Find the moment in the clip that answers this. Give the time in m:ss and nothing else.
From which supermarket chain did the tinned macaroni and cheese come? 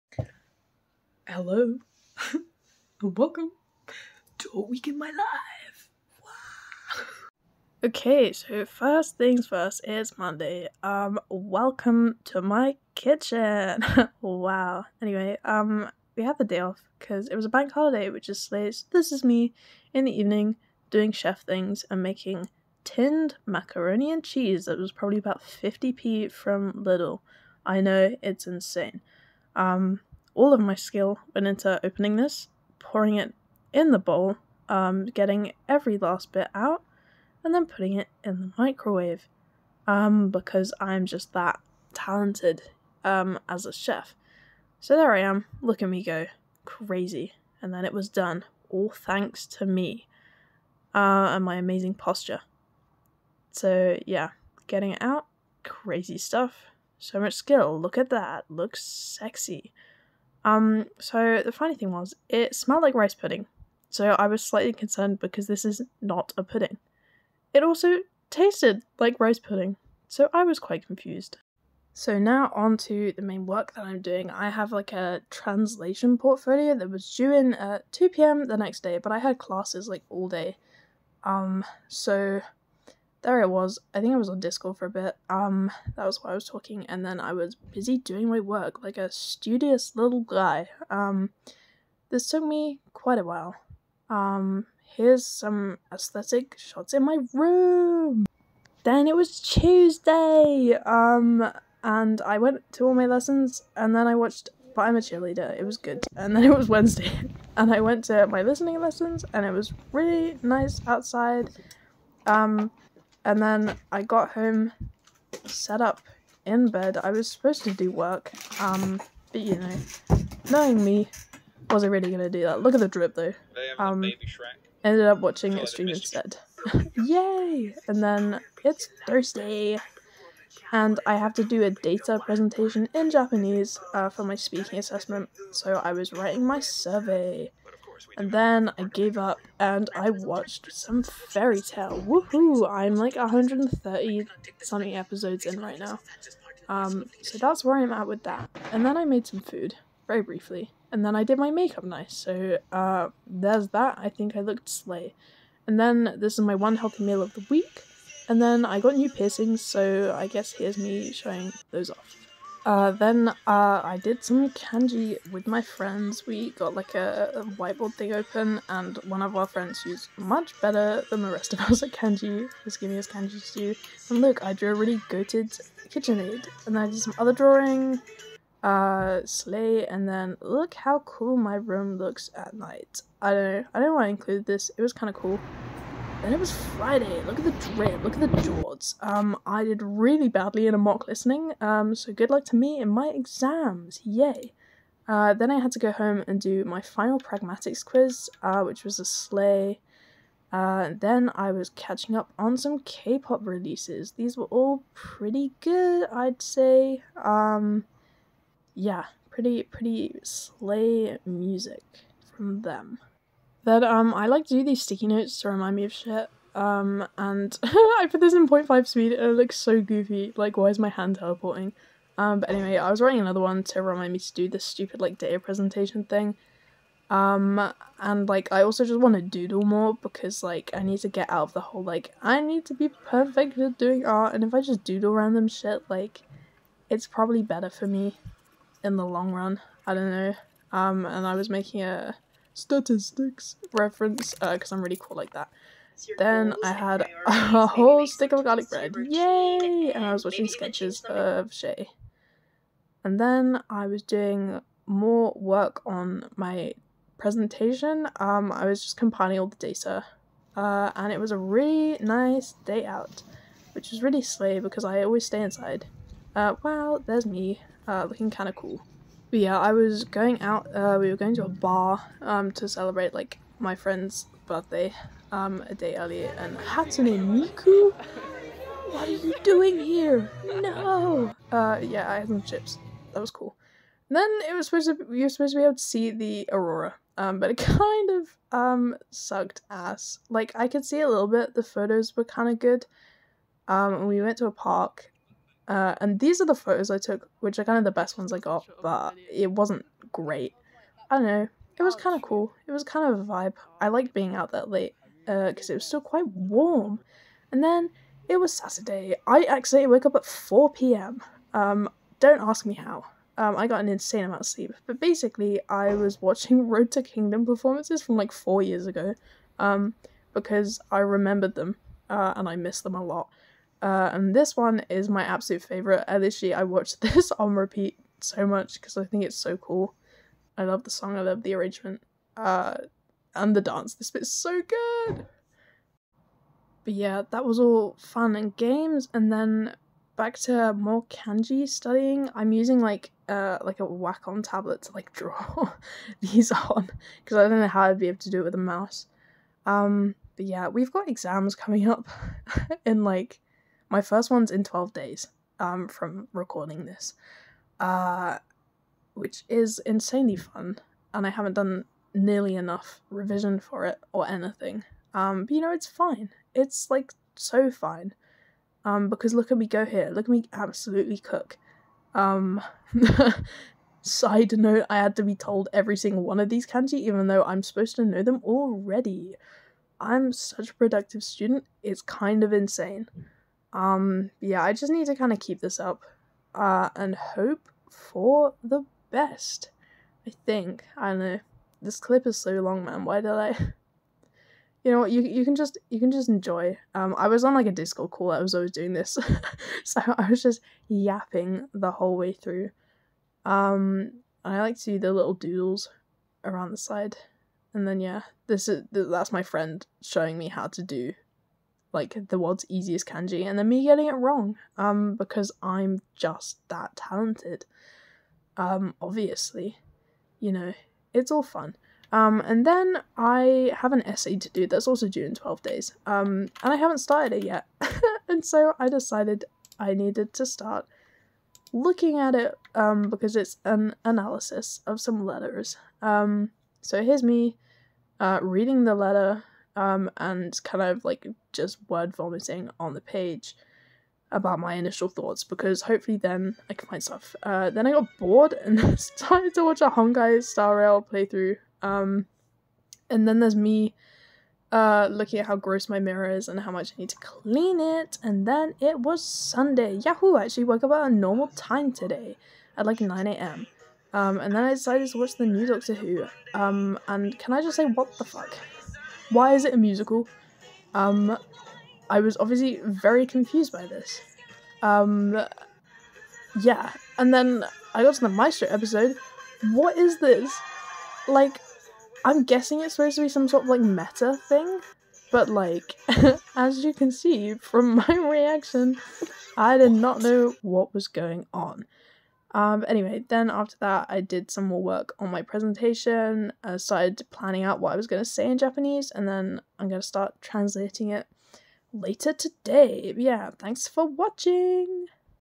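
0:26.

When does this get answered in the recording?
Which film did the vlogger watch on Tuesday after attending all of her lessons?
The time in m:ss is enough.
1:44.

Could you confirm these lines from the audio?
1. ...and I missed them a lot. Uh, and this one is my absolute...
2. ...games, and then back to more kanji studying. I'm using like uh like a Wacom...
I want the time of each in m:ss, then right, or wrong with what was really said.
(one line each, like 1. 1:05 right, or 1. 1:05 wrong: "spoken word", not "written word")
1. 5:22 right
2. 5:38 right.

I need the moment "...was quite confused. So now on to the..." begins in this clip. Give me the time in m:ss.
1:10.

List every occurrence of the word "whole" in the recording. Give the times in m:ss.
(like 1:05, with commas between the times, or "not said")
3:51, 4:07, 6:41.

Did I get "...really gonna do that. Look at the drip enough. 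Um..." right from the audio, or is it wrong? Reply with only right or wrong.
wrong.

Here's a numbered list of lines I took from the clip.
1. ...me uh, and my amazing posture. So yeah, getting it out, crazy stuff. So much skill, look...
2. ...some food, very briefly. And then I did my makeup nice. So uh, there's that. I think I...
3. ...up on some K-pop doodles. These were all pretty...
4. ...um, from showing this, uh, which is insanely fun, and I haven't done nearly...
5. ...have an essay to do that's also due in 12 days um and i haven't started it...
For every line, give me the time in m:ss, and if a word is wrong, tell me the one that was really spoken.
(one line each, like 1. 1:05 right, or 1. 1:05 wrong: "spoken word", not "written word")
1. 0:49 right
2. 2:29 right
3. 3:22 wrong: "releases", not "doodles"
4. 5:55 wrong: "recording", not "showing"
5. 7:03 right.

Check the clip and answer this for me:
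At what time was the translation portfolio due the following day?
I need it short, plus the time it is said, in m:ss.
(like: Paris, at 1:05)
2 p.m., at 1:17.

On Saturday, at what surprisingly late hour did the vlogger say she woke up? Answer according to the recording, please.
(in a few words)
4 p.m.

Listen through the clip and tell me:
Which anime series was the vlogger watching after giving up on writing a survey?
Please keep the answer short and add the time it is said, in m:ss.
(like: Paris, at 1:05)
Fairy Tail, at 2:21.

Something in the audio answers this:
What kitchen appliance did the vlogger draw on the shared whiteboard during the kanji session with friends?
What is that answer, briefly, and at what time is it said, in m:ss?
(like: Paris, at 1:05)
KitchenAid, at 2:55.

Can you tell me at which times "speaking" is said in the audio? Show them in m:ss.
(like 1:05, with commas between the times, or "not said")
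2:14.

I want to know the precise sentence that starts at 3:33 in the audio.
Then um, I like to do these sticky notes to remind me of shit.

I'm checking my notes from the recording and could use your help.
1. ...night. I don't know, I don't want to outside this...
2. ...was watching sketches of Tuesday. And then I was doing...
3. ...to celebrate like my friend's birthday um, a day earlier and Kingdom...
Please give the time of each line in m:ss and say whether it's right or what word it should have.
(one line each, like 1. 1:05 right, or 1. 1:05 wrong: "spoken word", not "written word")
1. 3:02 wrong: "include", not "outside"
2. 4:10 wrong: "Shay", not "Tuesday"
3. 4:32 wrong: "Hatsune", not "Kingdom".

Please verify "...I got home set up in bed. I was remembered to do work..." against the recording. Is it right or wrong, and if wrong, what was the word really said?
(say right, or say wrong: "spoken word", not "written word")
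wrong: "supposed", not "remembered".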